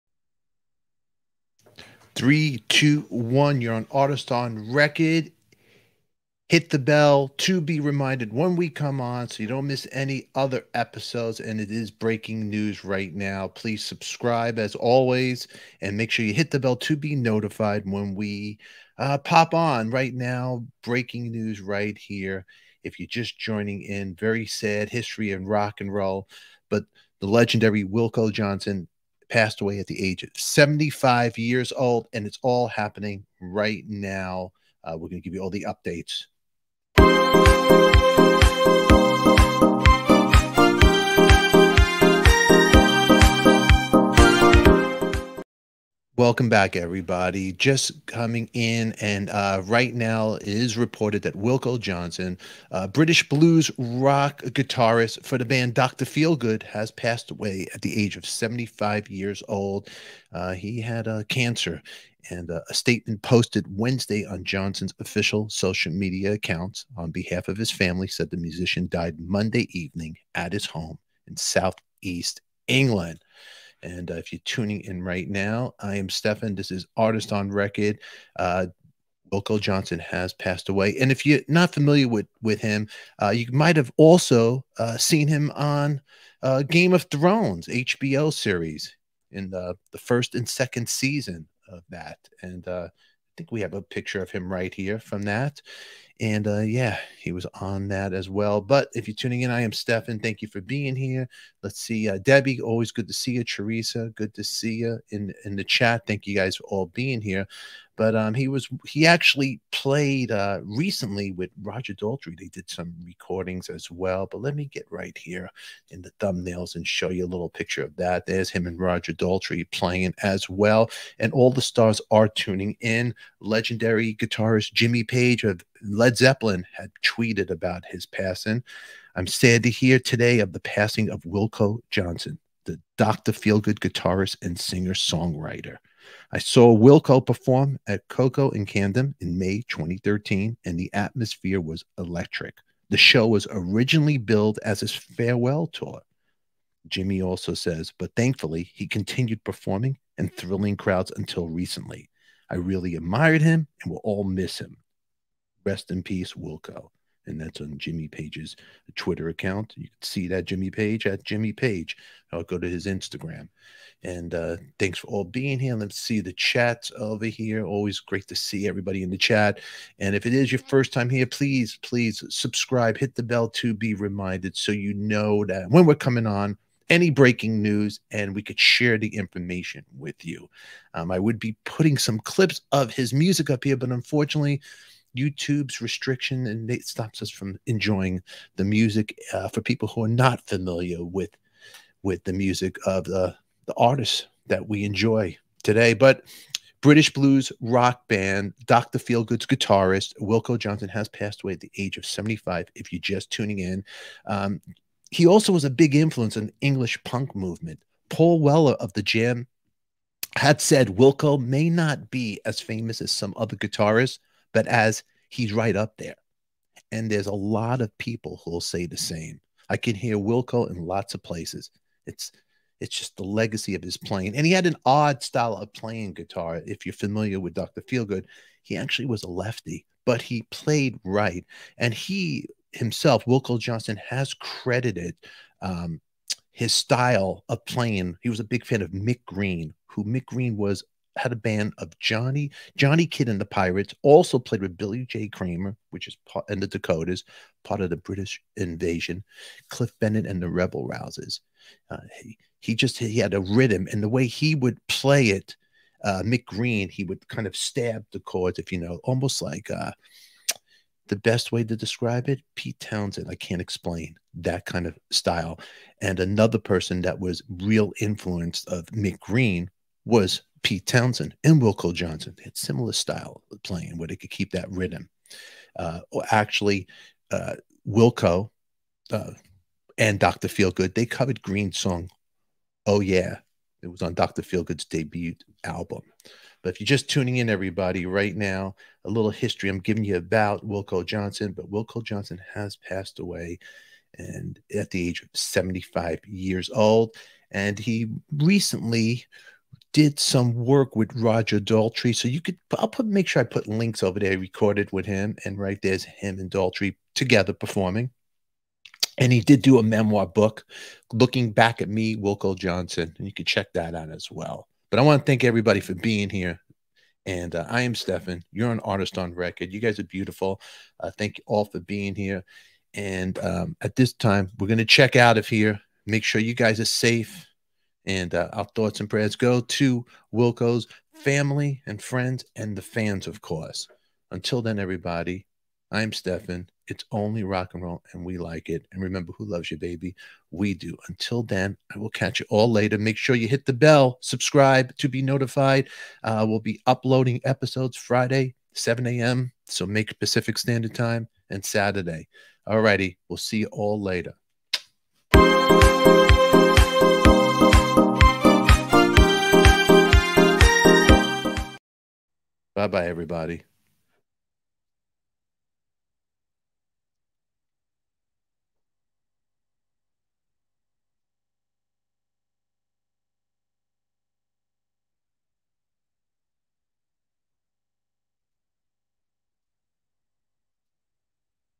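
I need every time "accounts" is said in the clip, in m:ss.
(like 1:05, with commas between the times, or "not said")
1:06, 2:39.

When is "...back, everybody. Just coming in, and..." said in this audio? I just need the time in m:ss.
0:46.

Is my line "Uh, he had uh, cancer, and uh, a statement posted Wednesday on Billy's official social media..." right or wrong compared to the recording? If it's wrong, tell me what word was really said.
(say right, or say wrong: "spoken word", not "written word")
wrong: "Johnson", not "Billy".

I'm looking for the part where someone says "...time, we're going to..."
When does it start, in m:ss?
5:24.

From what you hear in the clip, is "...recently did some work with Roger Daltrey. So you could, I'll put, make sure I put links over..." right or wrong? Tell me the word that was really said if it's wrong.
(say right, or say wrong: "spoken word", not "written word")
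right.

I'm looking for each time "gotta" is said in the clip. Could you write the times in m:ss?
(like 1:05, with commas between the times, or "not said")
not said.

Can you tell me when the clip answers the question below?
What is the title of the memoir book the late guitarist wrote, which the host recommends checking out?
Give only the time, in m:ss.
5:11.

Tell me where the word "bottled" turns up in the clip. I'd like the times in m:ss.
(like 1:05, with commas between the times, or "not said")
not said.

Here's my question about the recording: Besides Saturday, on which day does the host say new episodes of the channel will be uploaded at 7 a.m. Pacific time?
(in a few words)
Friday.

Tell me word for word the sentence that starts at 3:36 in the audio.
And there's a lot of people who'll say the same.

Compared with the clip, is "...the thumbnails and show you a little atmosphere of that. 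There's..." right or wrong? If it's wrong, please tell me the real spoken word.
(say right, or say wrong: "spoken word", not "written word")
wrong: "picture", not "atmosphere".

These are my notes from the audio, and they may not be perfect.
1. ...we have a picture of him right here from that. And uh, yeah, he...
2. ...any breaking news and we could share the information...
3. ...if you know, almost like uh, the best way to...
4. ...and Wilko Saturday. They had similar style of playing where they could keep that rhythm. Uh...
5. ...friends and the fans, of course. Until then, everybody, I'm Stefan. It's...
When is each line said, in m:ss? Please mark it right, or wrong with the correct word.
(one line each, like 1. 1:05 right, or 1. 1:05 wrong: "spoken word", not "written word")
1. 1:33 right
2. 2:56 right
3. 4:18 right
4. 4:31 wrong: "Johnson", not "Saturday"
5. 5:32 right.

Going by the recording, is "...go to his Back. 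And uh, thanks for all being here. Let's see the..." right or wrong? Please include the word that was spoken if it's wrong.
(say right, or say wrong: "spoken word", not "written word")
wrong: "Instagram", not "Back".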